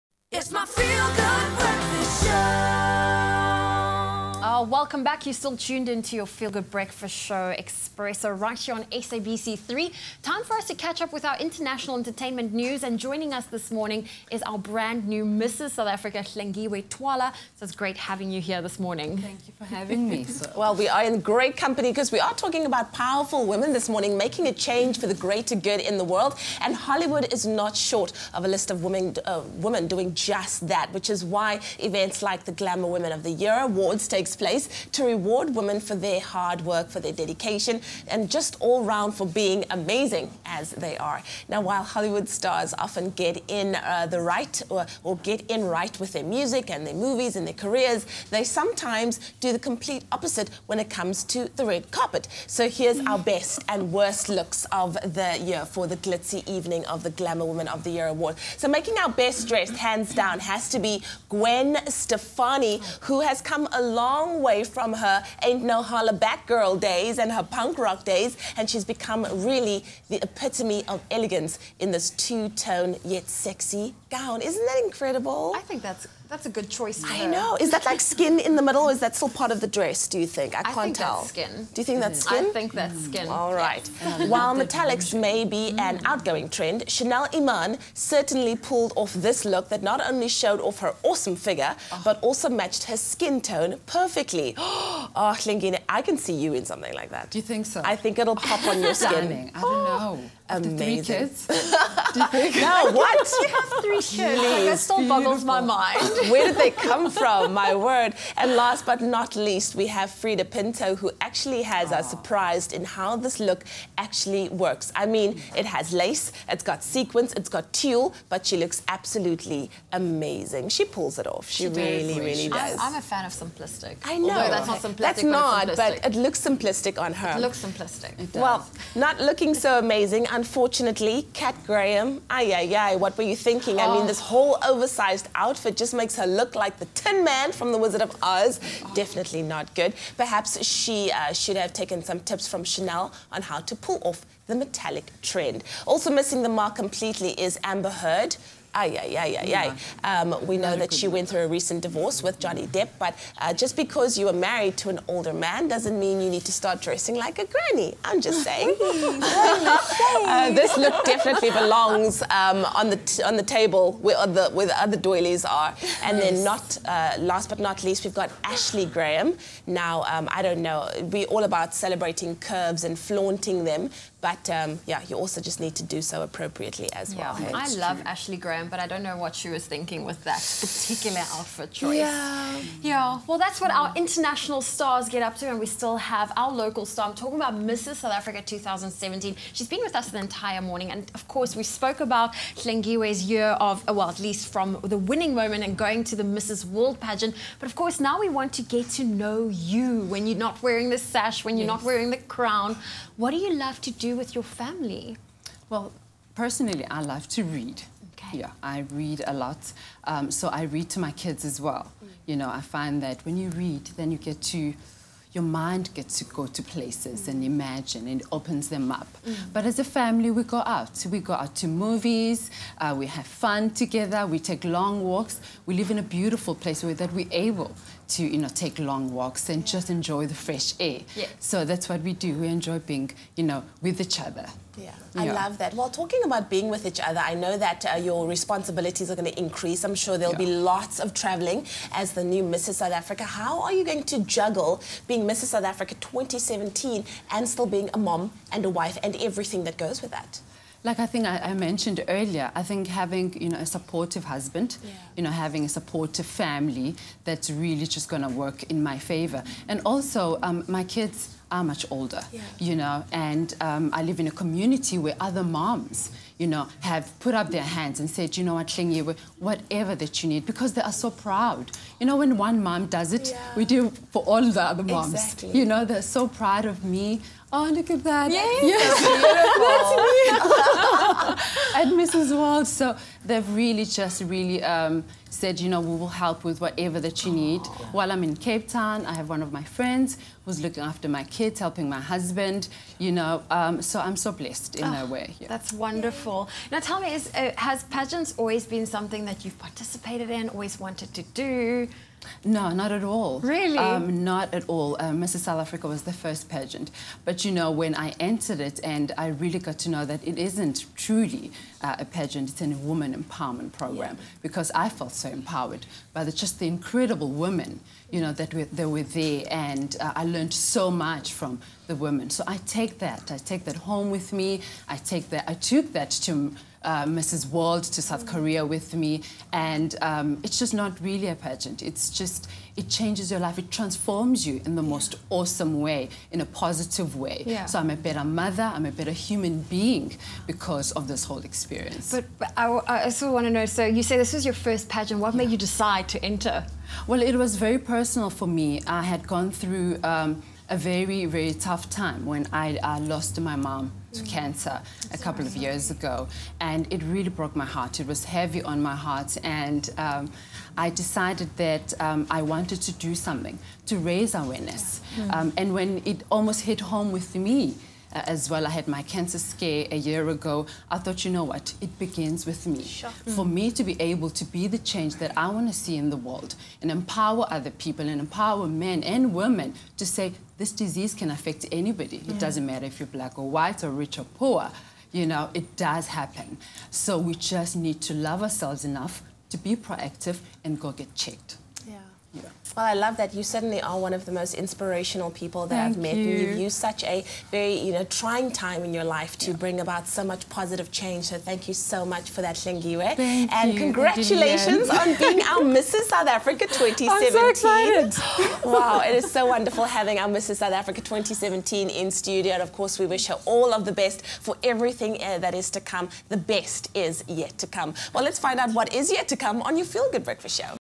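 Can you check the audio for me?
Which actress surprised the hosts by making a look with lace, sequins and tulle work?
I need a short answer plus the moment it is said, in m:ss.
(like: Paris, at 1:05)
Freida Pinto, at 1:50.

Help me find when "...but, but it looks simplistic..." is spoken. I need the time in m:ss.
2:05.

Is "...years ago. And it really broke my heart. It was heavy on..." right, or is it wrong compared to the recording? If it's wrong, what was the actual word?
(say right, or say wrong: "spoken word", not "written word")
right.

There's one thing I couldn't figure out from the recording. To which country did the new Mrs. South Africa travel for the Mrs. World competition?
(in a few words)
South Korea.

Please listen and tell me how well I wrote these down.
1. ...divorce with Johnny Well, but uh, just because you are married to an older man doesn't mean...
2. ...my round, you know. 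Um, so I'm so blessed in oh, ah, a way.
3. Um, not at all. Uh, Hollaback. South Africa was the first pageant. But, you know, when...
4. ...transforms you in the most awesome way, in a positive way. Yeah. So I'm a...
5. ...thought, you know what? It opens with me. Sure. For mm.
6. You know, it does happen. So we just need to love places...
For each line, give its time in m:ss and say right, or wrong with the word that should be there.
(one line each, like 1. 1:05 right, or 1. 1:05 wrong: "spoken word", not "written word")
1. 2:31 wrong: "Depp", not "Well"
2. 4:51 wrong: "husband", not "round"
3. 5:03 wrong: "Mrs", not "Hollaback"
4. 5:33 right
5. 6:10 wrong: "begins", not "opens"
6. 6:25 wrong: "ourselves", not "places".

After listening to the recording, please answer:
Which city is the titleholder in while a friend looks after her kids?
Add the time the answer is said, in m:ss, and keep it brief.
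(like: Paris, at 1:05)
Cape Town, at 4:48.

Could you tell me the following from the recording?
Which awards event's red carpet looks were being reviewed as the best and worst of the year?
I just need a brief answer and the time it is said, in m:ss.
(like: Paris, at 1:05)
Glamour Women of the Year Awards, at 0:32.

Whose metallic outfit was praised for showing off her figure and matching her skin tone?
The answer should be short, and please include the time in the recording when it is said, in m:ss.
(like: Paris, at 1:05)
Chanel Iman, at 1:26.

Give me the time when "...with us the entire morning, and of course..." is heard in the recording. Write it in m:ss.
3:09.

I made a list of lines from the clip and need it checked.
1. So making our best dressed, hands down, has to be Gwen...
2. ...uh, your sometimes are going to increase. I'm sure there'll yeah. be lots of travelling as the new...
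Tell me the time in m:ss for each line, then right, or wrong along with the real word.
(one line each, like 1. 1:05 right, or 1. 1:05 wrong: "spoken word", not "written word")
1. 0:58 right
2. 3:57 wrong: "responsibilities", not "sometimes".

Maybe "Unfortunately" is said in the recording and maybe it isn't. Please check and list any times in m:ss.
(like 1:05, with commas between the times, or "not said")
2:10.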